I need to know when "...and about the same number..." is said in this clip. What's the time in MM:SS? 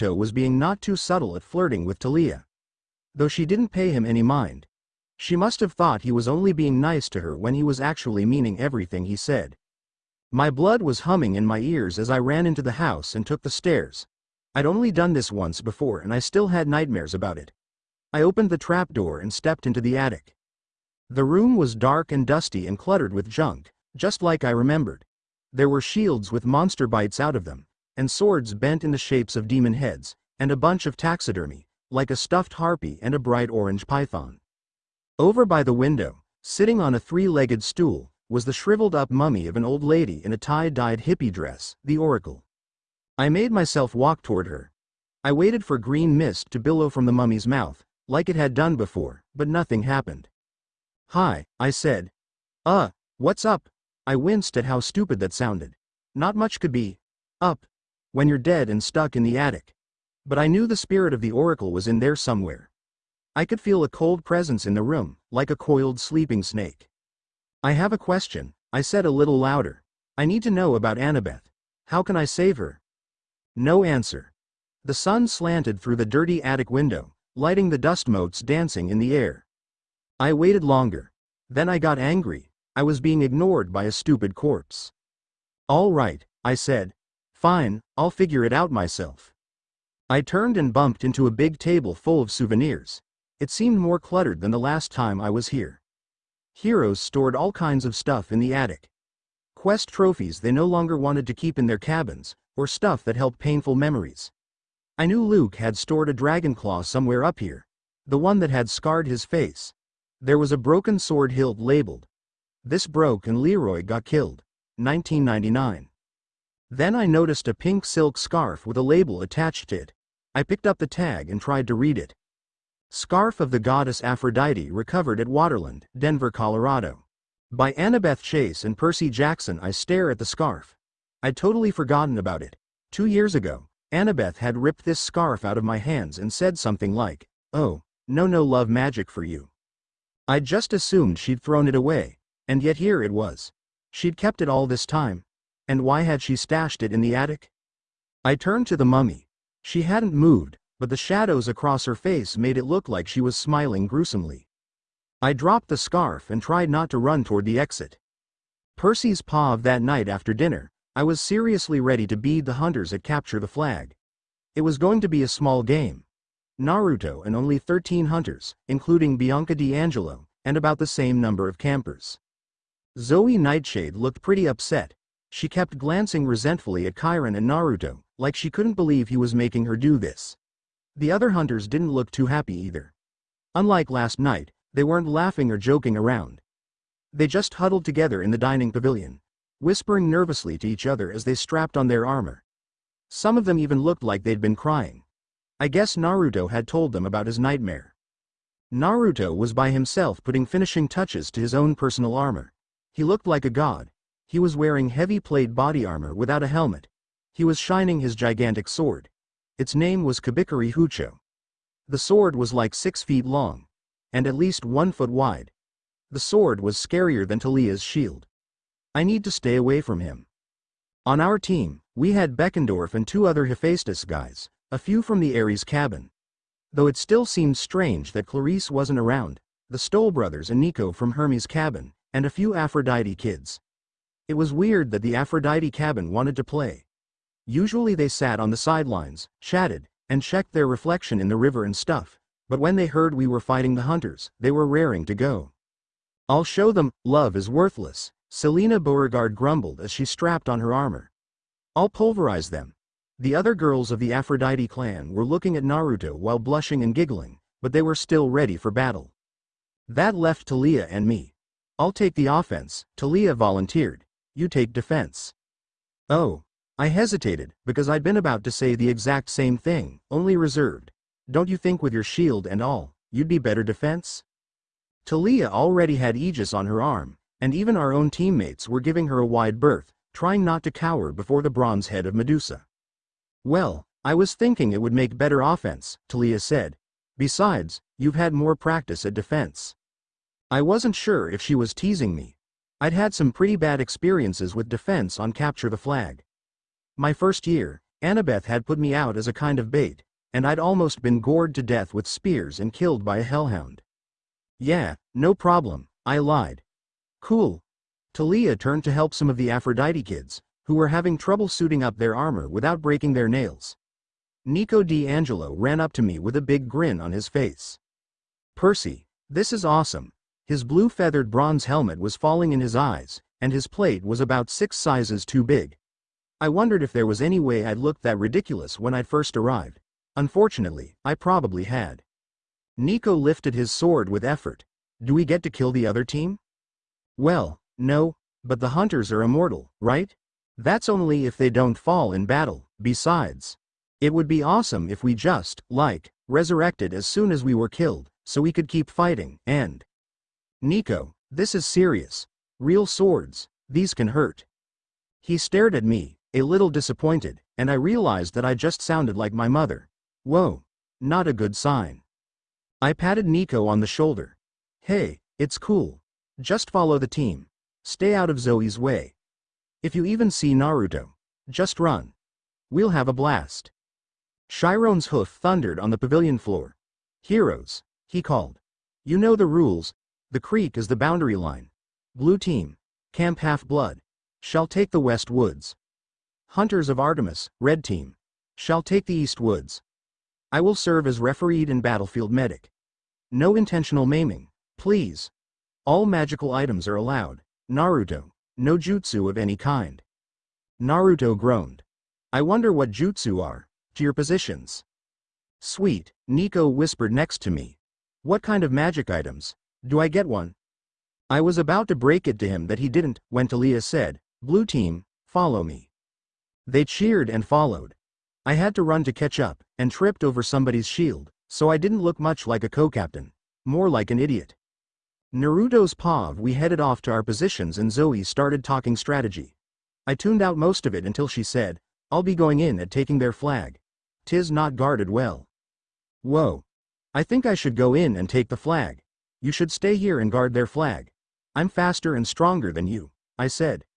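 02:50.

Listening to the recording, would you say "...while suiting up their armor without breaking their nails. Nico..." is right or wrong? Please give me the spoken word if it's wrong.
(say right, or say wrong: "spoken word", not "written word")
wrong: "trouble", not "while".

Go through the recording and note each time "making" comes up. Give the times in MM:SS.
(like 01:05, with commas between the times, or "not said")
02:59.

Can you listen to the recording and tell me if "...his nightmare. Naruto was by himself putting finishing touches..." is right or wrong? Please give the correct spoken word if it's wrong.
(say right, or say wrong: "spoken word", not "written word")
right.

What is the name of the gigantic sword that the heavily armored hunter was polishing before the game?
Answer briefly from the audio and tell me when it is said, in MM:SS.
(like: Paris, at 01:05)
Kubikiribocho, at 03:30.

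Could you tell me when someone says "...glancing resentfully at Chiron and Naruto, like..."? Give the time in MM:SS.
02:55.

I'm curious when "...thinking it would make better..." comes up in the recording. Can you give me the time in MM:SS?
04:44.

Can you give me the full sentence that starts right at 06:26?
Hunters of Artemis, Red team, shall take the east woods.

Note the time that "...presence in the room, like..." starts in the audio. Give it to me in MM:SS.
01:04.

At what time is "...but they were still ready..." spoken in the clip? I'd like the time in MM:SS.
04:17.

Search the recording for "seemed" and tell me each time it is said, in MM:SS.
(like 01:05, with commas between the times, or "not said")
01:33, 03:47.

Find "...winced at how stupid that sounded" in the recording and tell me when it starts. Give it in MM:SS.
00:54.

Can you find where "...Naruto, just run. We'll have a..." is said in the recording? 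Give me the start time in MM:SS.
06:10.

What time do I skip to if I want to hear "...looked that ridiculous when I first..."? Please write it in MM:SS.
05:27.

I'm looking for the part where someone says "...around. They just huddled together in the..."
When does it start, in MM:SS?
03:05.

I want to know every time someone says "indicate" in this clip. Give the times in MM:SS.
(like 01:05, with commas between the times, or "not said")
not said.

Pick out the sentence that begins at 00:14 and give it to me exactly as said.
I'd only done this once before and I still had nightmares about it.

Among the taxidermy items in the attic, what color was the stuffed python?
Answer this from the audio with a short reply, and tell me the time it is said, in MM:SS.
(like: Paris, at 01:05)
bright orange, at 00:33.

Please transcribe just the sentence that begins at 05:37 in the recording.
Well, no, but the hunters are immortal, right?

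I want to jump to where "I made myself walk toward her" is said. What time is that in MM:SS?
00:43.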